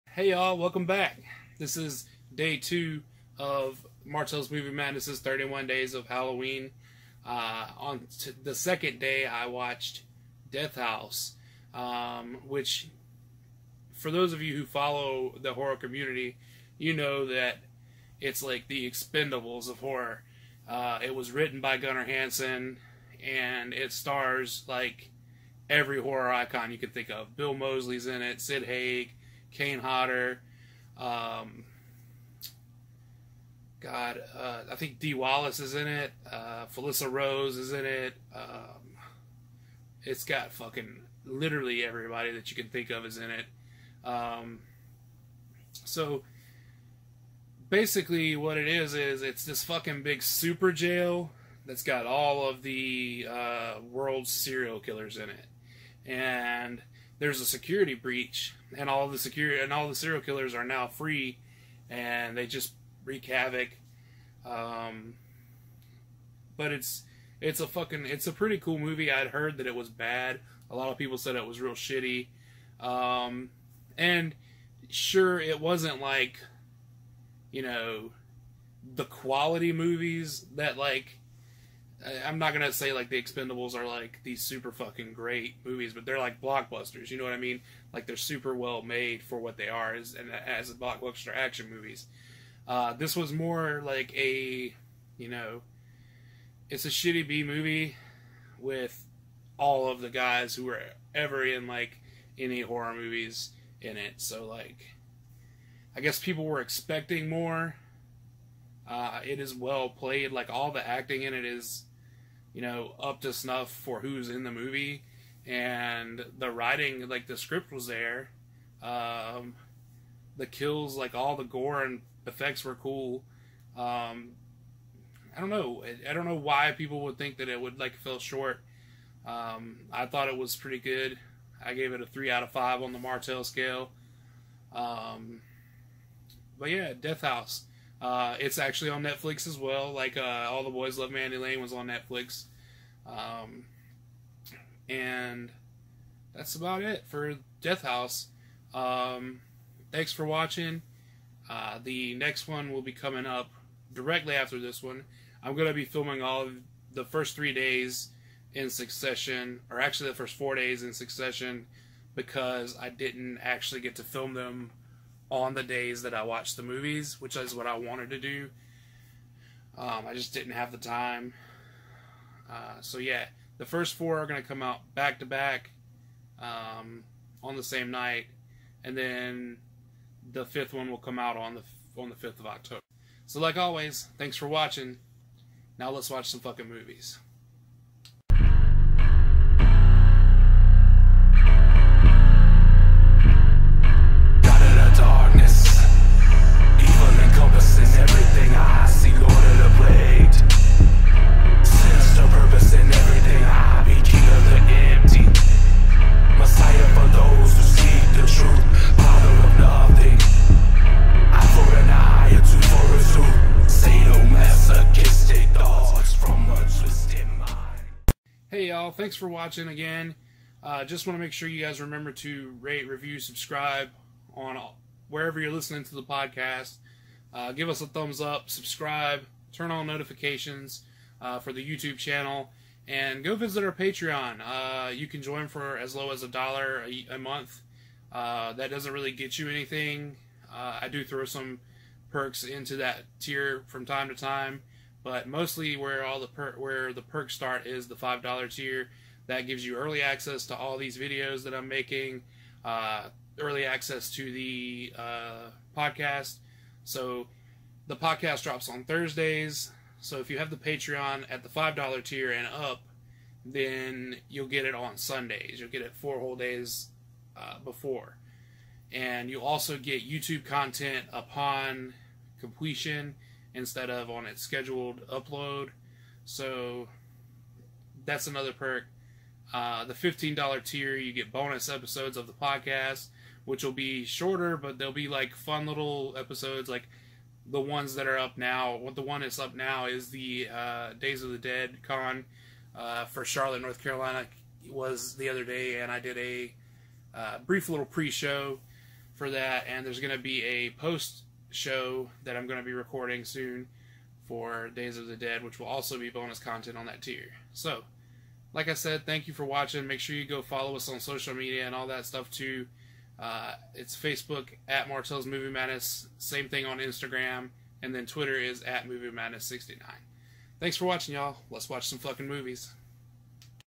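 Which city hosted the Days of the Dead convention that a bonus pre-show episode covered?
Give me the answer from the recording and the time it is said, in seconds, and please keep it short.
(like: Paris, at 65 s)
Charlotte, North Carolina, at 293 s.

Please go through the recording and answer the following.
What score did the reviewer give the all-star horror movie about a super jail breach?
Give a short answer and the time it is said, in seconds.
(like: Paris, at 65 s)
3 out of 5, at 132 s.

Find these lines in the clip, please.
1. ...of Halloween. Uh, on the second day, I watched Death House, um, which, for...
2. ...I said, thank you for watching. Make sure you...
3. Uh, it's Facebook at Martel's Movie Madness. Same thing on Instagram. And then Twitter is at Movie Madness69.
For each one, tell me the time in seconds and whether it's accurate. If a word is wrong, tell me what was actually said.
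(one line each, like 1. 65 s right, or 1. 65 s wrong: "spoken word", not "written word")
1. 5 s right
2. 308 s right
3. 313 s right.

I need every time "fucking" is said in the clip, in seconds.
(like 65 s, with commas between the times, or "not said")
40 s, 49 s, 67 s, 84 s, 186 s, 321 s.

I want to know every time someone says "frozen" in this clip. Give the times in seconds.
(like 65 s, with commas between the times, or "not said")
not said.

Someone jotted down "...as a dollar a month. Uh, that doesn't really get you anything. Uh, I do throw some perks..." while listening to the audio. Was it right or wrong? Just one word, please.
right.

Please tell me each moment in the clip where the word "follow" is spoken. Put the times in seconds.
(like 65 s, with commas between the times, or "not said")
14 s, 310 s.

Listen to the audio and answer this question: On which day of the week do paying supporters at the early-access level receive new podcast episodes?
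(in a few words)
Sundays.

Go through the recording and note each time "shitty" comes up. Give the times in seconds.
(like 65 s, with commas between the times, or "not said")
71 s, 96 s.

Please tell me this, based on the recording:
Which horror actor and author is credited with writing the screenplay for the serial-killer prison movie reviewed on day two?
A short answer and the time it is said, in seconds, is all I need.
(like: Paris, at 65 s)
Gunnar Hansen, at 21 s.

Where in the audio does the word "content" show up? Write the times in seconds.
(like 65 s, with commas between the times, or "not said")
270 s, 306 s.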